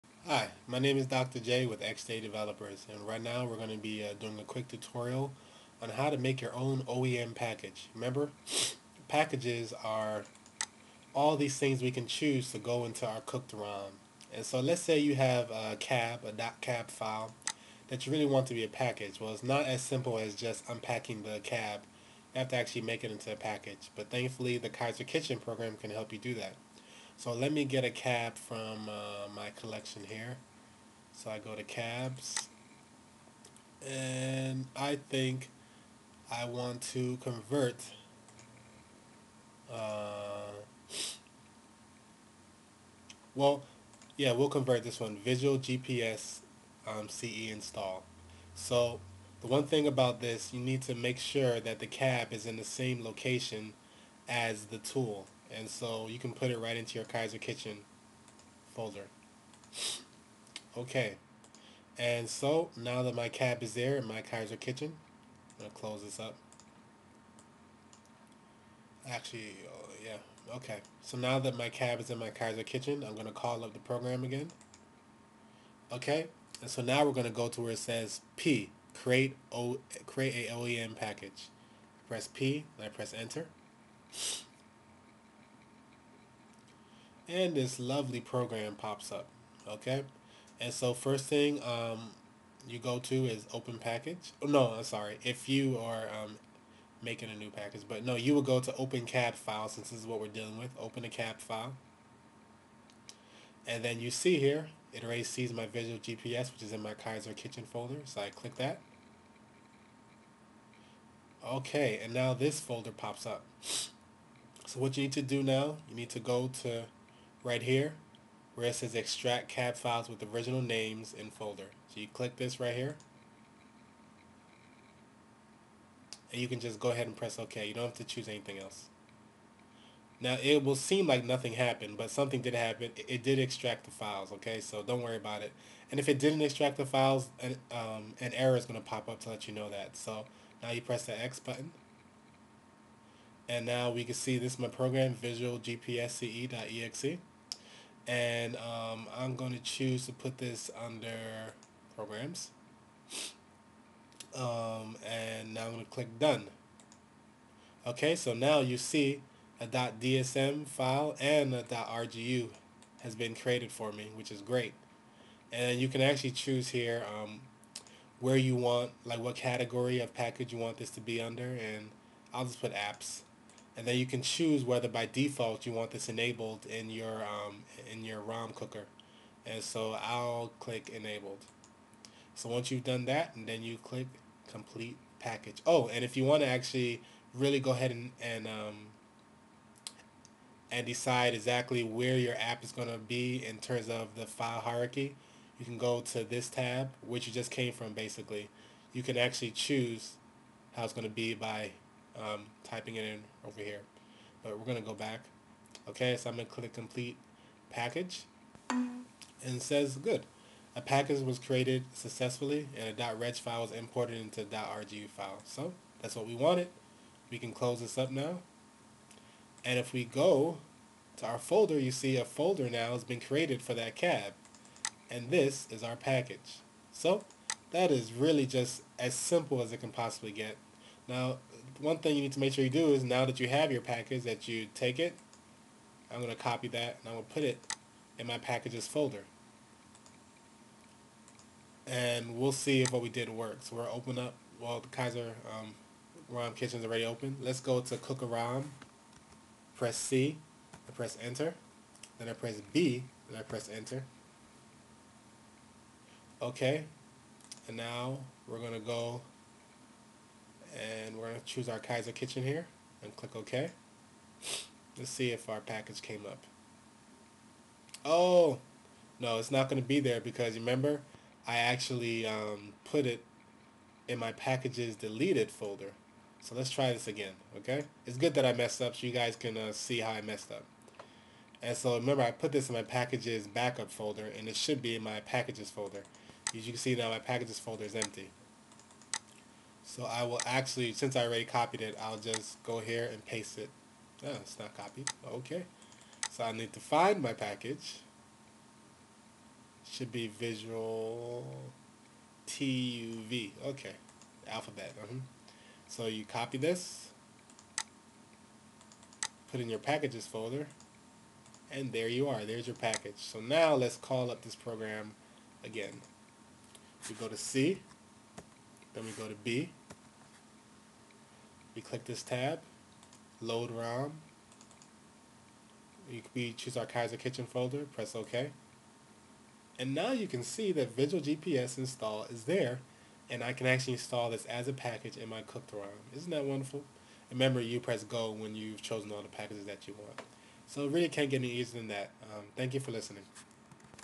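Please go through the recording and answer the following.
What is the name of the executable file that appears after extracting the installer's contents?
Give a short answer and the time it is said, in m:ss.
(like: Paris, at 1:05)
visualgpsce.exe, at 2:25.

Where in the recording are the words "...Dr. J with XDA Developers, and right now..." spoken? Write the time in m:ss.
0:01.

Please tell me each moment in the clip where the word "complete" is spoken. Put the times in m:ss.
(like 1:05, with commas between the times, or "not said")
3:04, 3:26.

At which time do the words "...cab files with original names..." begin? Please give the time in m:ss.
1:59.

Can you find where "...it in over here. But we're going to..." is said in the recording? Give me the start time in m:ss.
3:22.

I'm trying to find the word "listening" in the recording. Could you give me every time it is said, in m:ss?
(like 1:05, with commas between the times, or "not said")
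5:42.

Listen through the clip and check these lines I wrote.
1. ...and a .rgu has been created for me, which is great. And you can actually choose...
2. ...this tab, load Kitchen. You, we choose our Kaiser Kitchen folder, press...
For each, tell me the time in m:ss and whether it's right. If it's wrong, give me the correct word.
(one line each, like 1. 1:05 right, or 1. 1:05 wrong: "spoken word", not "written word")
1. 2:41 right
2. 5:22 wrong: "ROM", not "Kitchen".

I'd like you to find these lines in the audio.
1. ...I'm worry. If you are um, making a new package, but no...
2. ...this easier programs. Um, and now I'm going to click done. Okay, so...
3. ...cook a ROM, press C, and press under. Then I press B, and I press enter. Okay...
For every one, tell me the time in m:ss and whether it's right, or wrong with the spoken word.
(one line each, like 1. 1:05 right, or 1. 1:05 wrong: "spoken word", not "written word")
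1. 1:34 wrong: "sorry", not "worry"
2. 2:30 wrong: "under", not "easier"
3. 4:07 wrong: "enter", not "under".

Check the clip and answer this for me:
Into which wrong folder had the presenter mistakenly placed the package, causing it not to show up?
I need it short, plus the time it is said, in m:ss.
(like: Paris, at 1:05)
packages deleted folder, at 4:34.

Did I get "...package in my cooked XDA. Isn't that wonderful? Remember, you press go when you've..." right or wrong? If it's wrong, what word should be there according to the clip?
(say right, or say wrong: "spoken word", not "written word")
wrong: "ROM", not "XDA".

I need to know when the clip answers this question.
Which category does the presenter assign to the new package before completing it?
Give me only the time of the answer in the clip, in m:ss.
2:52.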